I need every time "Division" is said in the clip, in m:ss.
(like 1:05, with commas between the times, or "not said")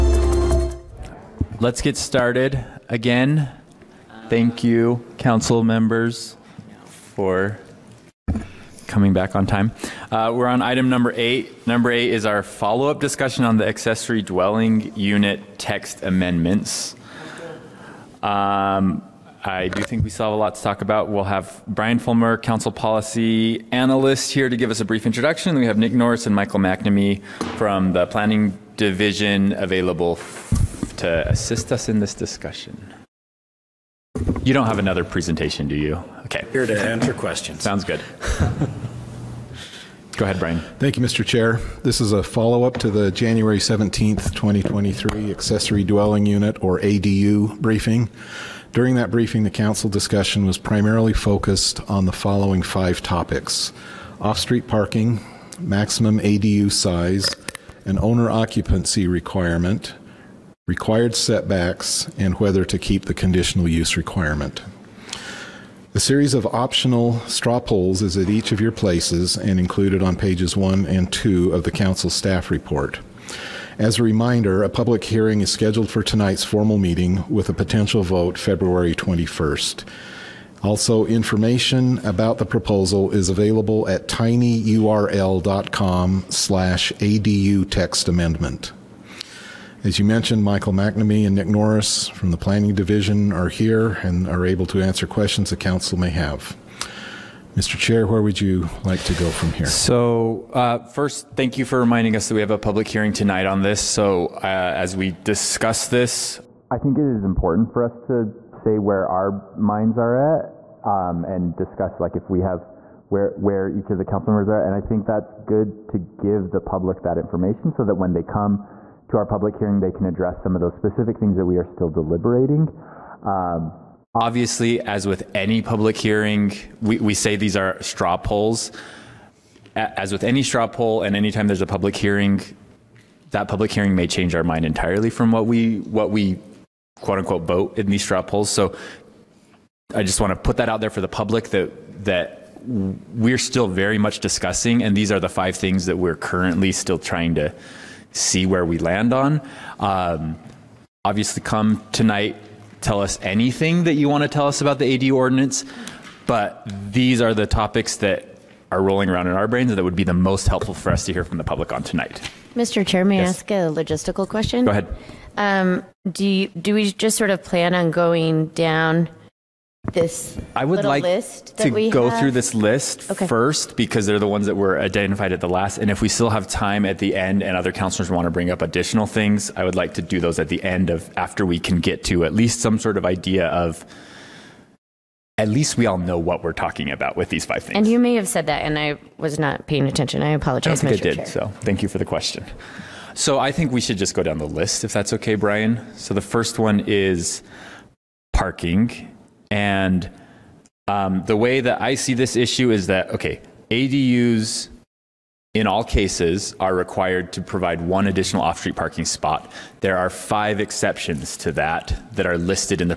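0:28, 1:32.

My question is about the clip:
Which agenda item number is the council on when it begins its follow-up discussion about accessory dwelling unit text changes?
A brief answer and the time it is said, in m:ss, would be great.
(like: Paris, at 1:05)
8, at 0:10.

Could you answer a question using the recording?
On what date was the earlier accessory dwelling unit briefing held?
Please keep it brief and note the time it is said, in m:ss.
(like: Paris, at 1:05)
January 17th, 2023, at 0:43.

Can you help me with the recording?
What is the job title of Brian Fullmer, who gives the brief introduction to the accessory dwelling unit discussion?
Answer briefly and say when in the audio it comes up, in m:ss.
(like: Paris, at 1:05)
Council Policy Analyst, at 0:22.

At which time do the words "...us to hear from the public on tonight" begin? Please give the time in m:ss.
2:40.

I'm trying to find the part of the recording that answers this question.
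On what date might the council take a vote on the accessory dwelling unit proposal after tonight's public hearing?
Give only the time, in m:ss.
1:18.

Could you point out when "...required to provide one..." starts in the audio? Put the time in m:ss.
3:26.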